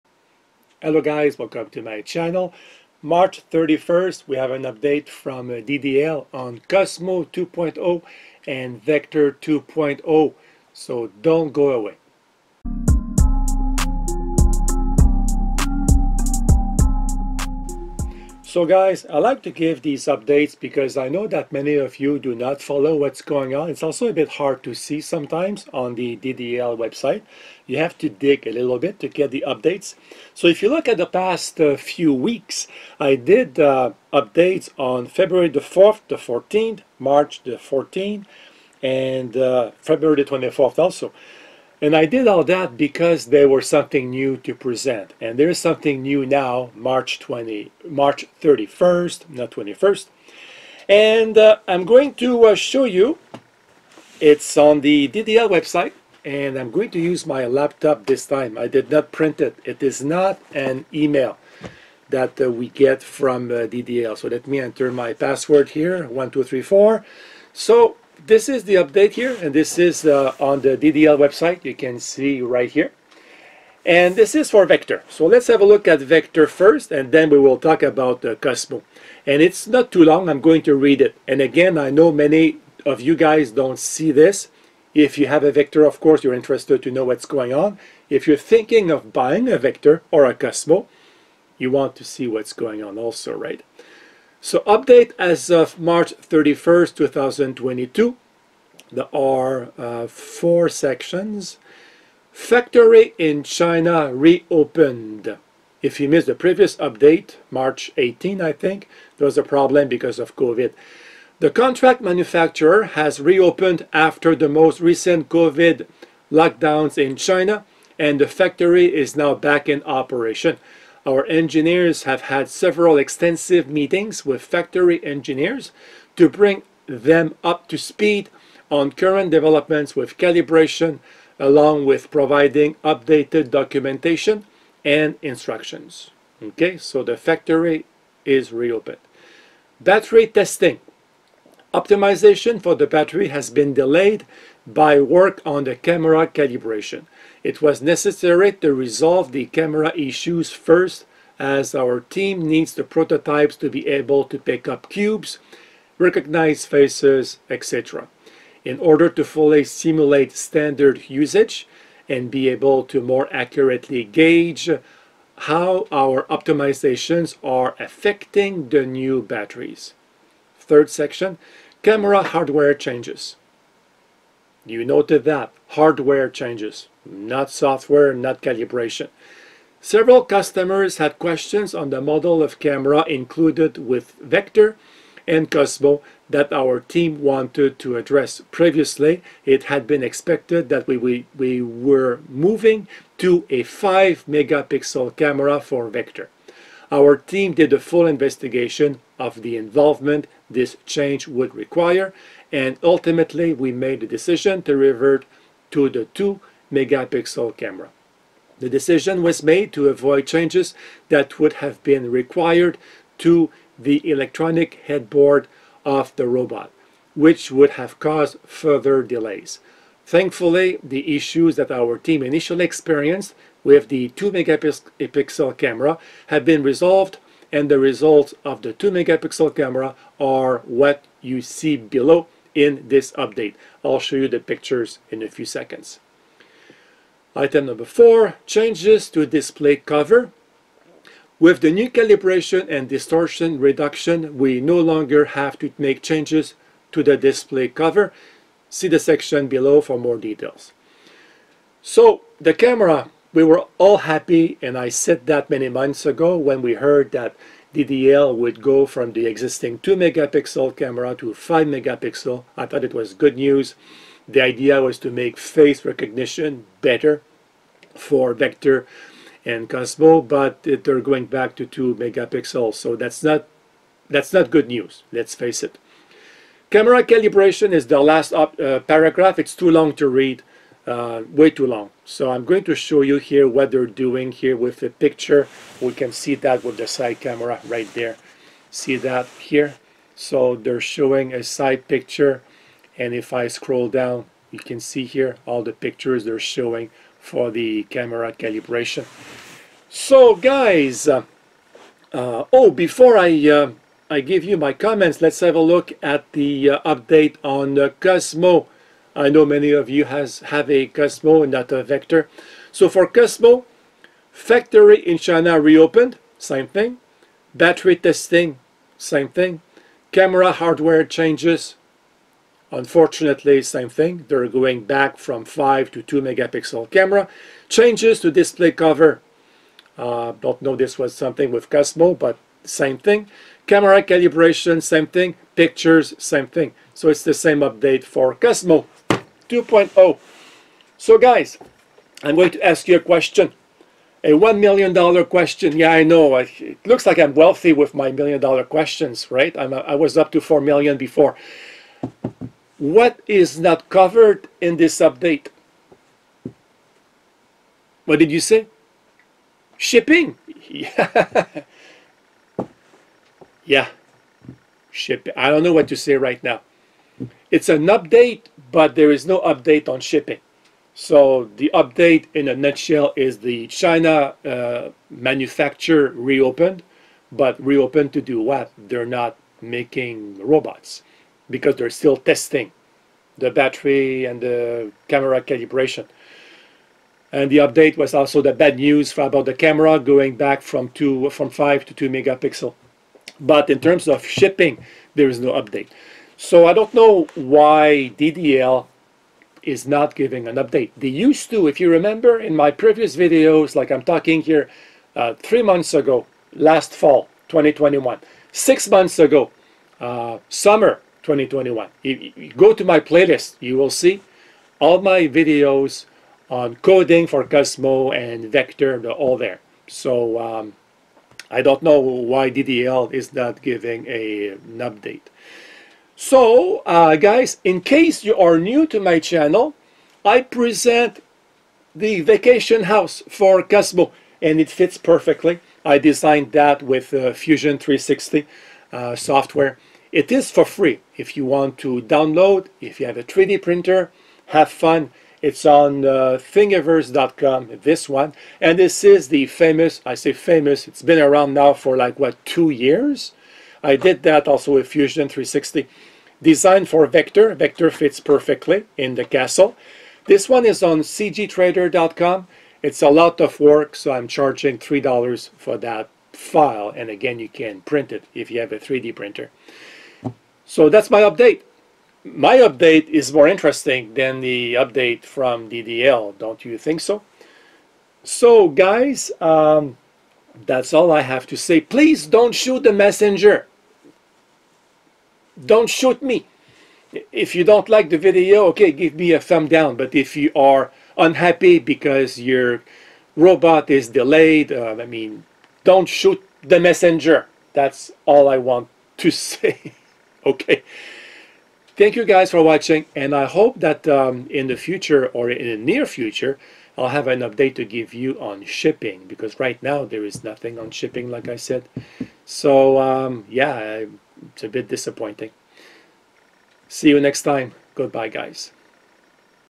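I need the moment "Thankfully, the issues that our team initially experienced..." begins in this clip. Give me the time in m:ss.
3:40.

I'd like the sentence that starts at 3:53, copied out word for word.
I'll show you the pictures in a few seconds.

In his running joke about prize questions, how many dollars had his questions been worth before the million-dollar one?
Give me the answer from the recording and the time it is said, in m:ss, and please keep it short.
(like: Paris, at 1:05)
$4, at 5:50.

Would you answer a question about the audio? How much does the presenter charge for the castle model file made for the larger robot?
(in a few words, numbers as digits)
$3.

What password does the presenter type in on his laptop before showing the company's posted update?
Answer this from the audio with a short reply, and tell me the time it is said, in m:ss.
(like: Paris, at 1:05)
1234, at 1:06.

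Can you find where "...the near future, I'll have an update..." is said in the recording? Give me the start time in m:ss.
8:25.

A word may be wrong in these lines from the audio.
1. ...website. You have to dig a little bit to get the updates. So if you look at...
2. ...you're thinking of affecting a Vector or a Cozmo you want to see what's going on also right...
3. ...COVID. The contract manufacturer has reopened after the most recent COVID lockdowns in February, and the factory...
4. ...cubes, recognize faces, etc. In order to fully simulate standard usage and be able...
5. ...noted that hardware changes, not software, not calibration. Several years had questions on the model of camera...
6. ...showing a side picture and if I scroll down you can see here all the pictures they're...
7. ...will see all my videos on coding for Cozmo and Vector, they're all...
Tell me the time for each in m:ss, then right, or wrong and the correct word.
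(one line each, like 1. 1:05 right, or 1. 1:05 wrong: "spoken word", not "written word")
1. 0:26 right
2. 1:28 wrong: "buying", not "affecting"
3. 1:50 wrong: "China", not "February"
4. 2:34 right
5. 2:54 wrong: "customers", not "years"
6. 4:50 right
7. 6:53 right.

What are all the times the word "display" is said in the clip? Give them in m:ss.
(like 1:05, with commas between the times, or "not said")
3:59, 4:07, 5:28.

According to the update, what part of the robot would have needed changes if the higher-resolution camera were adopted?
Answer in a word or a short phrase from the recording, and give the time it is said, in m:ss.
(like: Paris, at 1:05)
electronic headboard, at 3:34.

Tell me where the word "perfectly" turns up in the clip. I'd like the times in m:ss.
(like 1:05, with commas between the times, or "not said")
7:14, 7:38.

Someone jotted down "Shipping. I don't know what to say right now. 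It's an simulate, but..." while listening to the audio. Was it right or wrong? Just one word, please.
wrong.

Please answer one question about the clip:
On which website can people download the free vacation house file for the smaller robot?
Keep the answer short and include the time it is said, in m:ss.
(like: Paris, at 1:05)
thingiverse.com, at 7:26.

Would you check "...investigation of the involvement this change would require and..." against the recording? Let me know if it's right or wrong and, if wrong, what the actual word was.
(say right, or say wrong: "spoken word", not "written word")
right.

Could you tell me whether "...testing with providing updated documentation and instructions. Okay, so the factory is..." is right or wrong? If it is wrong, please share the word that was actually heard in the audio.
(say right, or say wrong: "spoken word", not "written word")
wrong: "along", not "testing".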